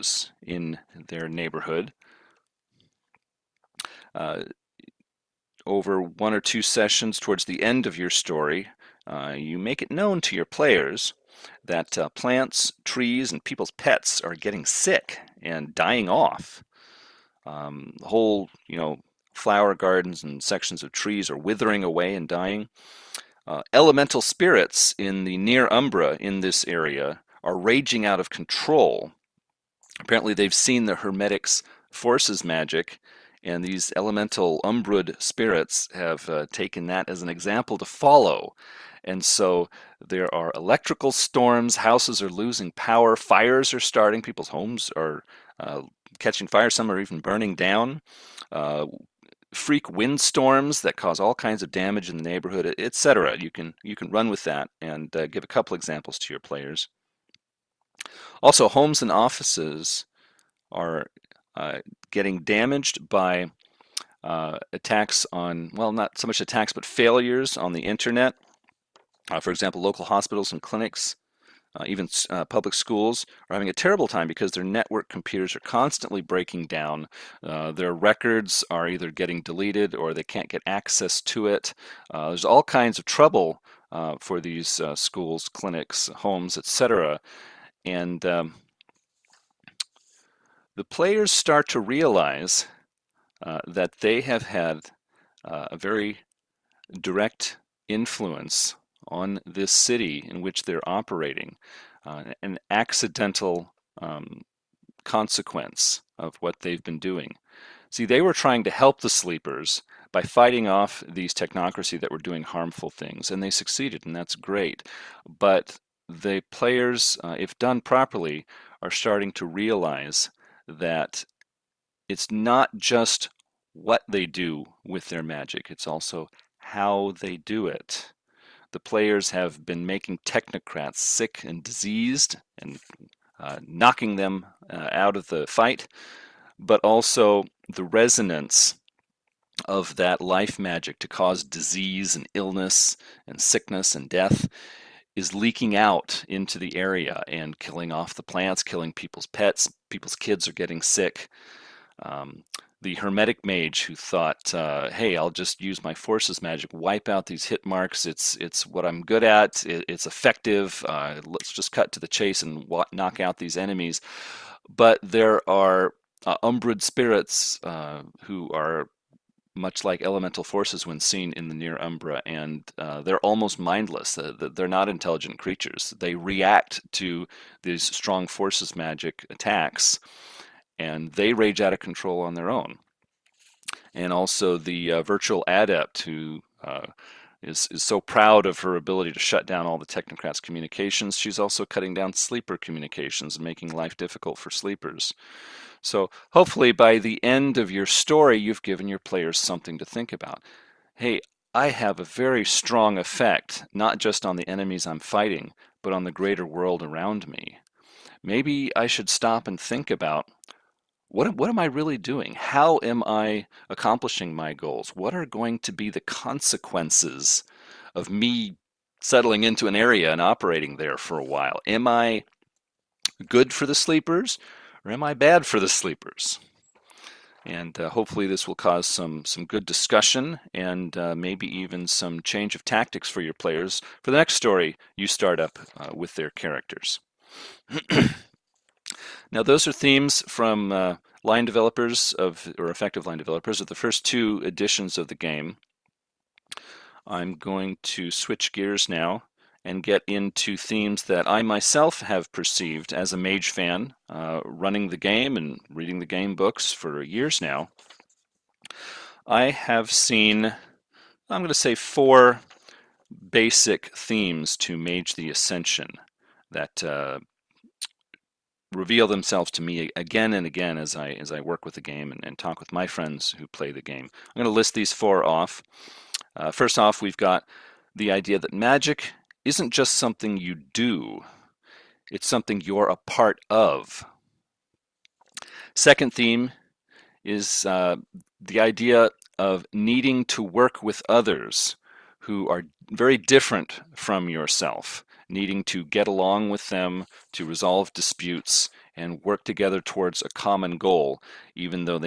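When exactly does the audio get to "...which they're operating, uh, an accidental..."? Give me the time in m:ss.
1:40.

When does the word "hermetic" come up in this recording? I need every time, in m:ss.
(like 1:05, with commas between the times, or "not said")
0:30, 2:32.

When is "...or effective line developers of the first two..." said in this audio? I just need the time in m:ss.
4:02.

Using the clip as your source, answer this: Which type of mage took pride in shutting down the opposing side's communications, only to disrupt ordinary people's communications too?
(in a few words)
Virtual adept.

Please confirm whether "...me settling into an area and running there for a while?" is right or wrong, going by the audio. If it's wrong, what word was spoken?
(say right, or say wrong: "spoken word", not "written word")
wrong: "operating", not "running".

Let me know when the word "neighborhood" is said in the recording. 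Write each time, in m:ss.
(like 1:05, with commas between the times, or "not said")
0:01, 0:52.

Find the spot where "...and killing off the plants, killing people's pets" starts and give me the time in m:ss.
2:27.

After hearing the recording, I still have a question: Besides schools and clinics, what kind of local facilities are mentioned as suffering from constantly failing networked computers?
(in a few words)
Hospitals.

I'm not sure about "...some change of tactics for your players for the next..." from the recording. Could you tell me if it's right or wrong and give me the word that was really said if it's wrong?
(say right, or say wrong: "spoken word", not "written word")
right.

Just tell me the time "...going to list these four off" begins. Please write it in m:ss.
4:34.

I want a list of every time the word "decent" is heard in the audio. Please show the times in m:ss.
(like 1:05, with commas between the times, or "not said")
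not said.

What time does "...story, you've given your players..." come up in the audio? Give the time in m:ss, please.
3:17.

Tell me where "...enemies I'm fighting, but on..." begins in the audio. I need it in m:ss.
3:24.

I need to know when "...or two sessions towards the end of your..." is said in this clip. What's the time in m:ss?
0:06.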